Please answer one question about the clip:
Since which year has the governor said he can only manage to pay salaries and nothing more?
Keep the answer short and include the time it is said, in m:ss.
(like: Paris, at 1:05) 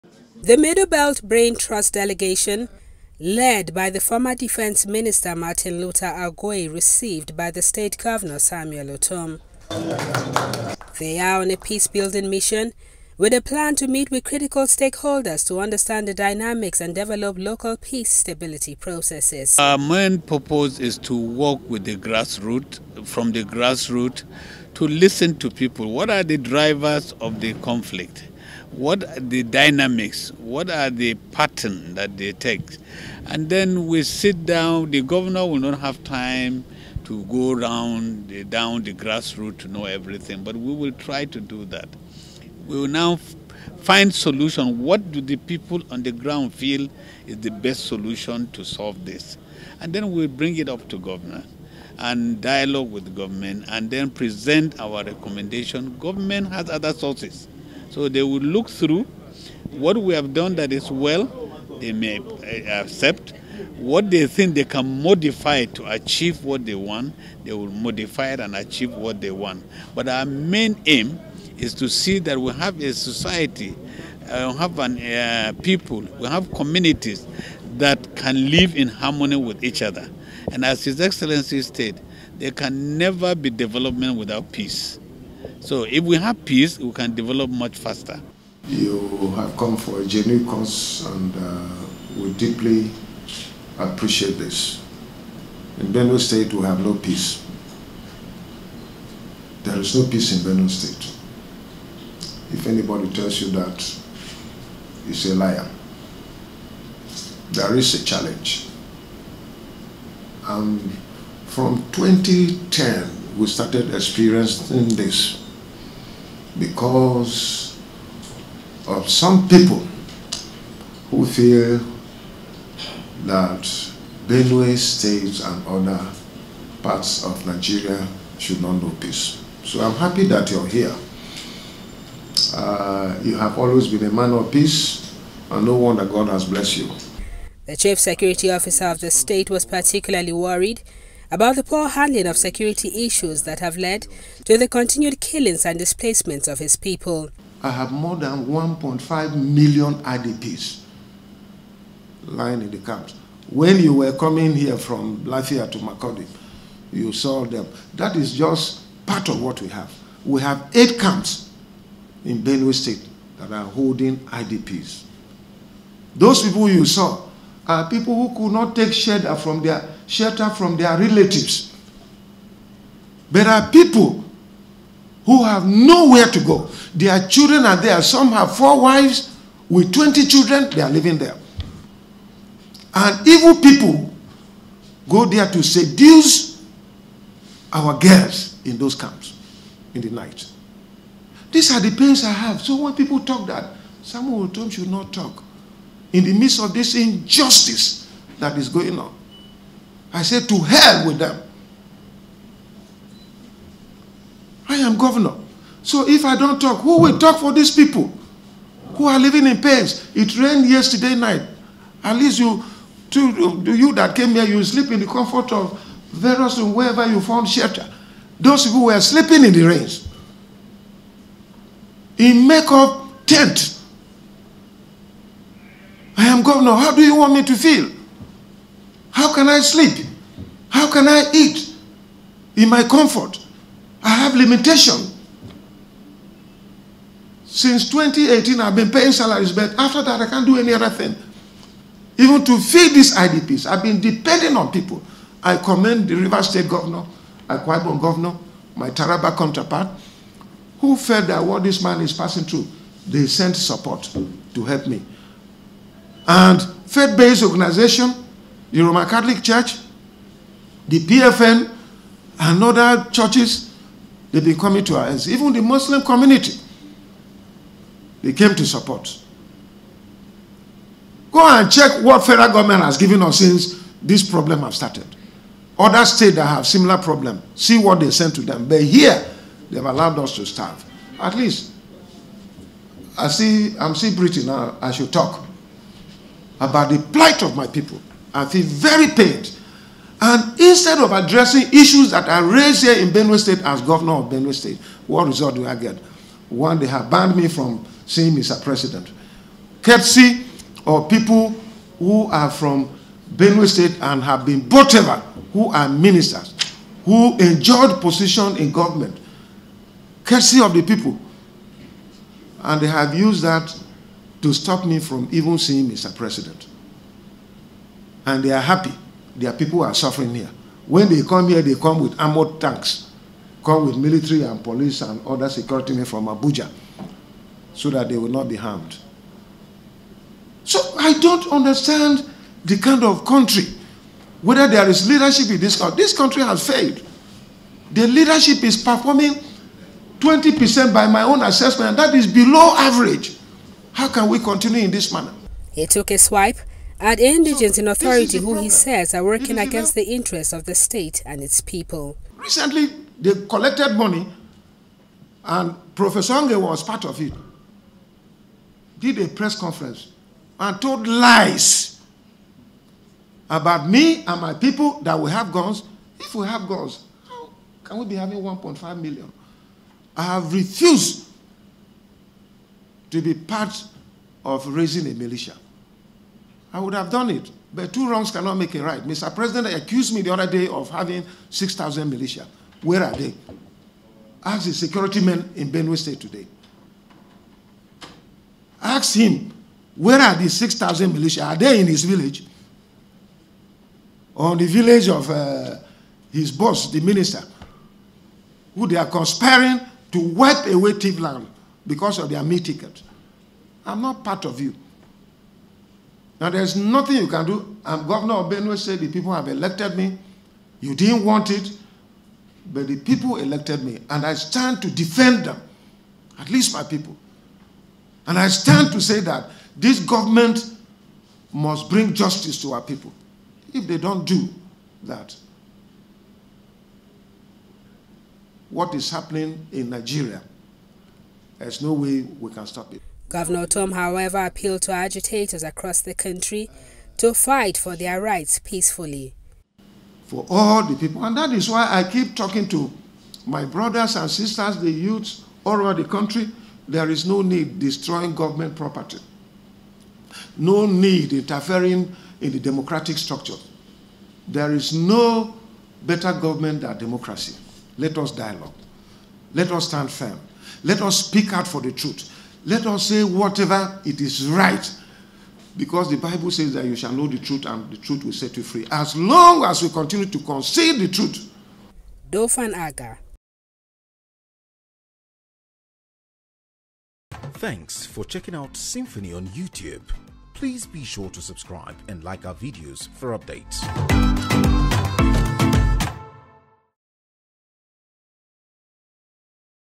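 2018, at 3:57.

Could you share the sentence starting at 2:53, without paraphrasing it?
There are people who have nowhere to go.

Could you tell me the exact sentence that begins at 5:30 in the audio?
So I don't understand the kind of country, whether there is leadership in this country.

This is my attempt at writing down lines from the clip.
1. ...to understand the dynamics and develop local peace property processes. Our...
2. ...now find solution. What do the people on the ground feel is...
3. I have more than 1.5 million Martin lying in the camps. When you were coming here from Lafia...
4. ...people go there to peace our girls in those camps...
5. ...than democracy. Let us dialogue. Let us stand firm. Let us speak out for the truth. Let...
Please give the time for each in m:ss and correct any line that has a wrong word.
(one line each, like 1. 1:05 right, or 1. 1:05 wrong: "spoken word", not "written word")
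1. 0:15 wrong: "stability", not "property"
2. 0:42 right
3. 2:27 wrong: "IDPs", not "Martin"
4. 3:03 wrong: "seduce", not "peace"
5. 7:36 right.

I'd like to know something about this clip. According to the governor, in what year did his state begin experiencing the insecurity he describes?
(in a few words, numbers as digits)
2010.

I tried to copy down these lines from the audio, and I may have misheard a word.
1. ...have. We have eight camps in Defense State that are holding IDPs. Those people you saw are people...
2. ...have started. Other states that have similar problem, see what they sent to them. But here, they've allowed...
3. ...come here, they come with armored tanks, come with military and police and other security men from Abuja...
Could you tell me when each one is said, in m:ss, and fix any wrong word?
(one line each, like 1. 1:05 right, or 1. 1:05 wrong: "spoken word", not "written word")
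1. 2:39 wrong: "Benue", not "Defense"
2. 4:34 right
3. 5:21 right.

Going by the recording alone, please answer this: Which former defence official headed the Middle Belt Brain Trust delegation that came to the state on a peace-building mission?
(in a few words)
Martin Luther Agwai.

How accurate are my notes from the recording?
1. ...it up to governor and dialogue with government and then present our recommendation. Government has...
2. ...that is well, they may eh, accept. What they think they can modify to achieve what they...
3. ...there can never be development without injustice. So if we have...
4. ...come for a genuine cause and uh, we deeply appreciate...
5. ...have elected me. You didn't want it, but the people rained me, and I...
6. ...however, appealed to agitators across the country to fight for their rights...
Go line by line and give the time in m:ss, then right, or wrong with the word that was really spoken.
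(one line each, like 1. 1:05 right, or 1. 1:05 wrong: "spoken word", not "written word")
1. 0:50 right
2. 1:00 right
3. 1:22 wrong: "peace", not "injustice"
4. 1:29 right
5. 6:49 wrong: "elected", not "rained"
6. 7:13 right.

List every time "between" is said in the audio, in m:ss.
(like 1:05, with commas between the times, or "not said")
not said.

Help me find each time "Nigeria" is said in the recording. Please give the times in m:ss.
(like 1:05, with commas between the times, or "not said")
2:07, 7:09.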